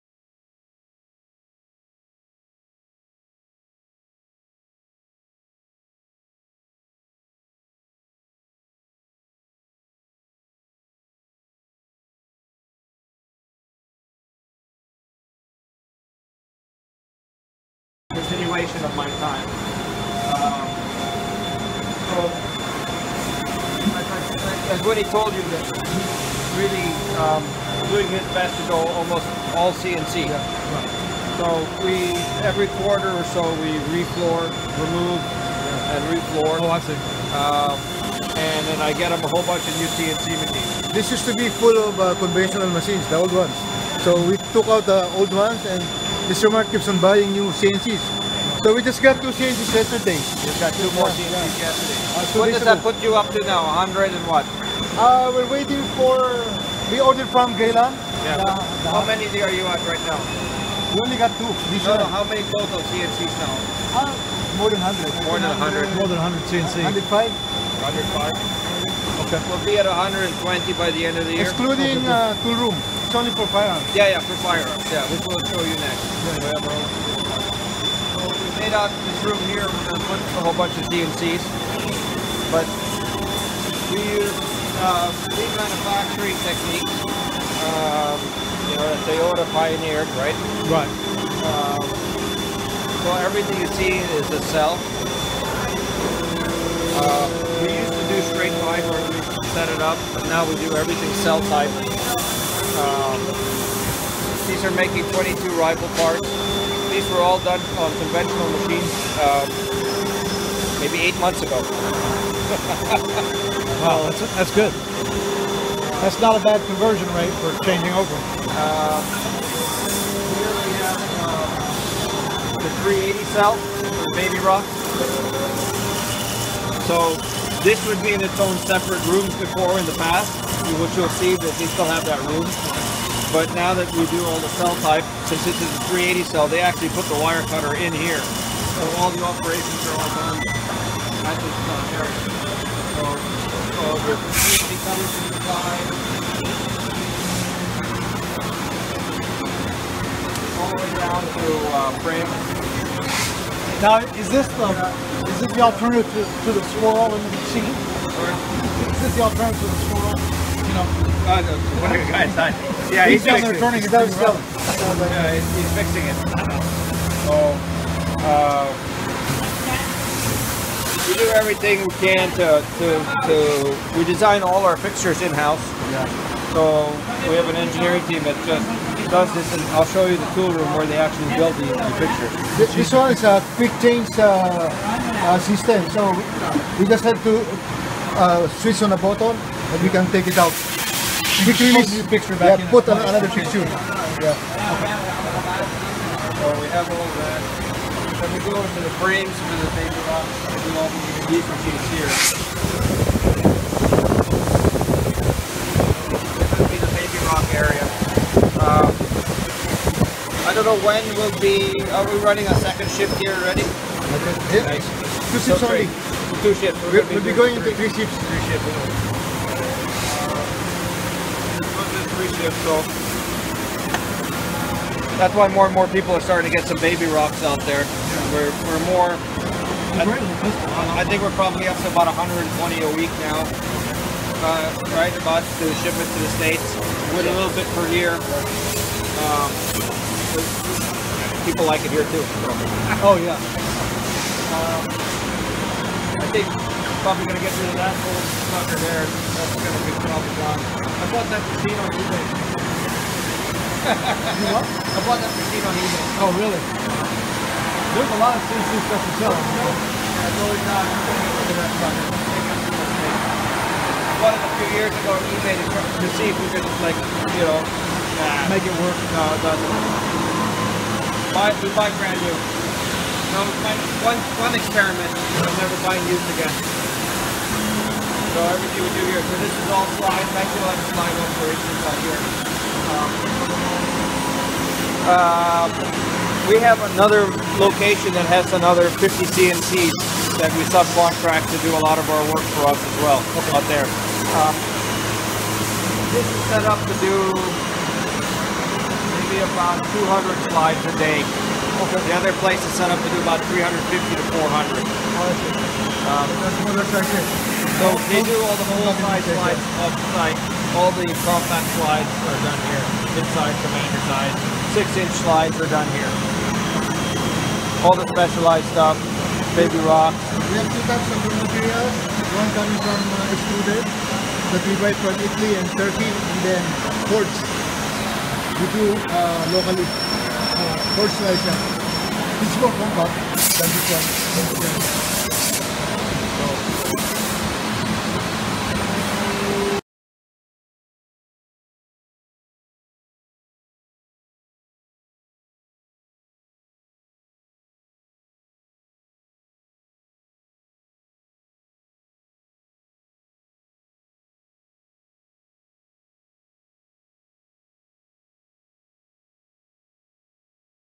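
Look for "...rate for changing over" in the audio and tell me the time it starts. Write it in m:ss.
1:57.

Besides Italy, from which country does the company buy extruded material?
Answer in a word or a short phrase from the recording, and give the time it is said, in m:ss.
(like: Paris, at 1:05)
Turkey, at 5:25.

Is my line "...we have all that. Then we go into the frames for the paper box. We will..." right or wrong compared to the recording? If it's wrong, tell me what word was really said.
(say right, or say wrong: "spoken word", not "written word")
right.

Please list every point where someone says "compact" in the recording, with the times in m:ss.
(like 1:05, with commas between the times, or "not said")
5:32.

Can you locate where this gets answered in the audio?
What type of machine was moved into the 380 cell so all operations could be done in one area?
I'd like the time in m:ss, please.
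2:17.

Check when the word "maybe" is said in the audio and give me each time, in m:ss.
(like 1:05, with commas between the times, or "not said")
1:50, 4:57.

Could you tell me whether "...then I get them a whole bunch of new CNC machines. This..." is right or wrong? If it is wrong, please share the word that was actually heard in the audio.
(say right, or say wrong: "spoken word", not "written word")
right.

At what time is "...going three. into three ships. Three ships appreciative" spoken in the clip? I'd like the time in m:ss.
3:37.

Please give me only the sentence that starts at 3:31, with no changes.
Are we running a second shift here already?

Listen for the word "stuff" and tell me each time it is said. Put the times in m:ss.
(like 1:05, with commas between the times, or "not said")
4:18, 5:18.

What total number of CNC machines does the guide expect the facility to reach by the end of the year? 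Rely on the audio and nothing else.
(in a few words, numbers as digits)
120.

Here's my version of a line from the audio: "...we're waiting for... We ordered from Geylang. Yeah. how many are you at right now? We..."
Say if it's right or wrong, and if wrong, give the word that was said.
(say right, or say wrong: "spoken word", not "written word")
right.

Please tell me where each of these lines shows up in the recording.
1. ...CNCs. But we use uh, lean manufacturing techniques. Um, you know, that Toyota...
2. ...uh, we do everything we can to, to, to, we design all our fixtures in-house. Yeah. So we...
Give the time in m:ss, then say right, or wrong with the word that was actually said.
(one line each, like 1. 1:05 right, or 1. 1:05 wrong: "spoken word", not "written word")
1. 1:20 right
2. 2:48 right.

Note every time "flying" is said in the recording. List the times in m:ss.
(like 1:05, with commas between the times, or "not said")
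4:40.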